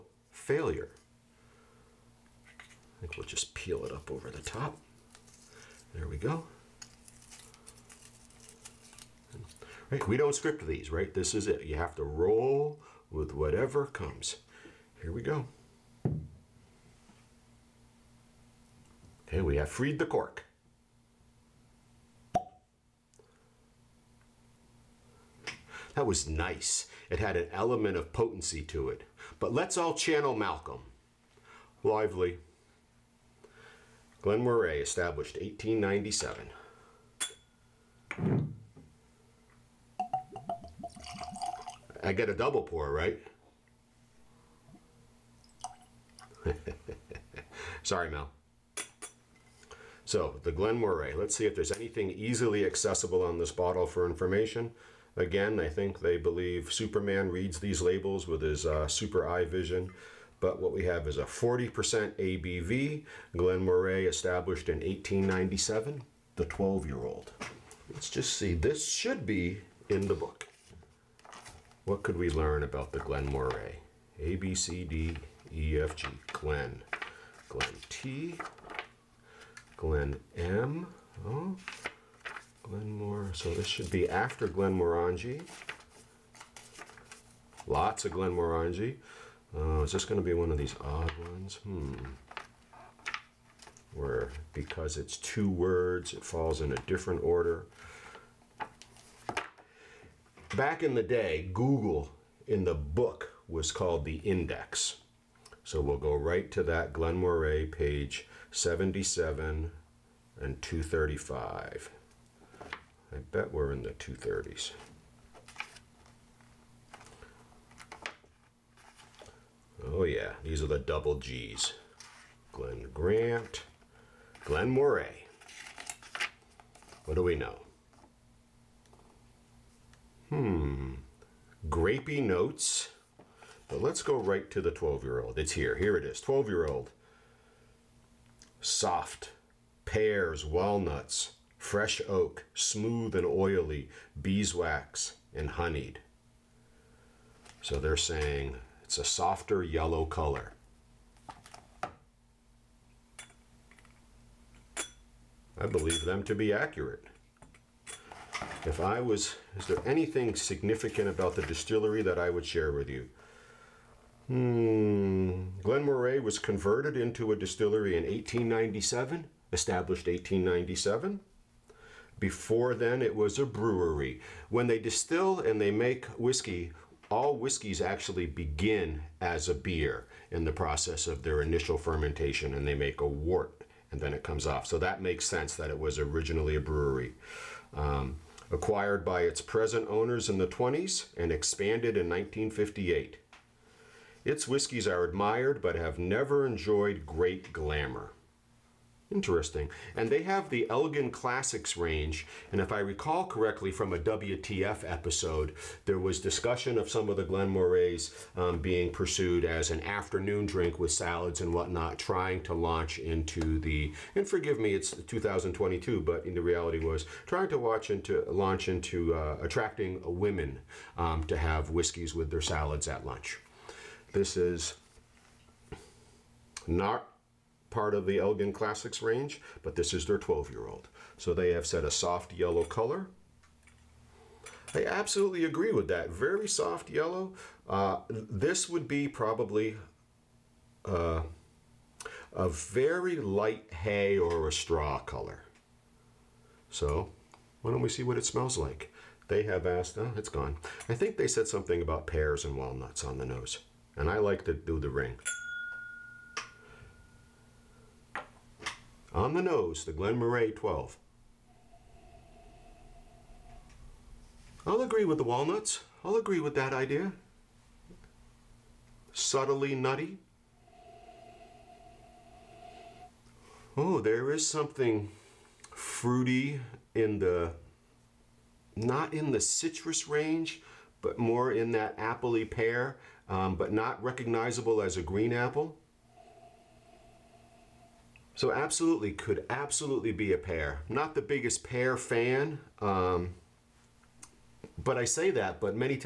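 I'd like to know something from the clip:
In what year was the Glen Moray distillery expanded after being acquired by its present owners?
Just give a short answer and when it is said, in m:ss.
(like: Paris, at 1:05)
1958, at 3:12.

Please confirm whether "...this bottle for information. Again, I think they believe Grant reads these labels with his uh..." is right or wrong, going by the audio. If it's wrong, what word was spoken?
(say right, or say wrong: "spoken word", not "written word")
wrong: "Superman", not "Grant".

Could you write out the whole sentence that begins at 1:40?
Back in the day, Google in the book was called the index.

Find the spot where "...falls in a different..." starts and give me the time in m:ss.
1:36.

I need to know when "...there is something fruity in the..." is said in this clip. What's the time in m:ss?
4:34.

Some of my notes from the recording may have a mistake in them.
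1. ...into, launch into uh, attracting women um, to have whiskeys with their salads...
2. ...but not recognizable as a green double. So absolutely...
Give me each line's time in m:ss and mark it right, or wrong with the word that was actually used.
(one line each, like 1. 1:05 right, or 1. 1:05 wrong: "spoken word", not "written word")
1. 3:37 right
2. 4:43 wrong: "apple", not "double".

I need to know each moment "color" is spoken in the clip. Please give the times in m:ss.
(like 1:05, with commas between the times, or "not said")
2:30, 3:52, 4:04.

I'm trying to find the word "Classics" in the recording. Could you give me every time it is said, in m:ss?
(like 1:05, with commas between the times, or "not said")
3:21, 3:48.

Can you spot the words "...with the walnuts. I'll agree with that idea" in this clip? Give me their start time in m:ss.
4:25.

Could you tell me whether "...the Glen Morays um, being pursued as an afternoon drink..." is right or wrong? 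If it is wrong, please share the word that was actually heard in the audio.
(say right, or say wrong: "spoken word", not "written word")
right.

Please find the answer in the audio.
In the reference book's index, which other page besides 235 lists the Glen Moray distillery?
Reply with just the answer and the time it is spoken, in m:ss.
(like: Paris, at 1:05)
77, at 1:47.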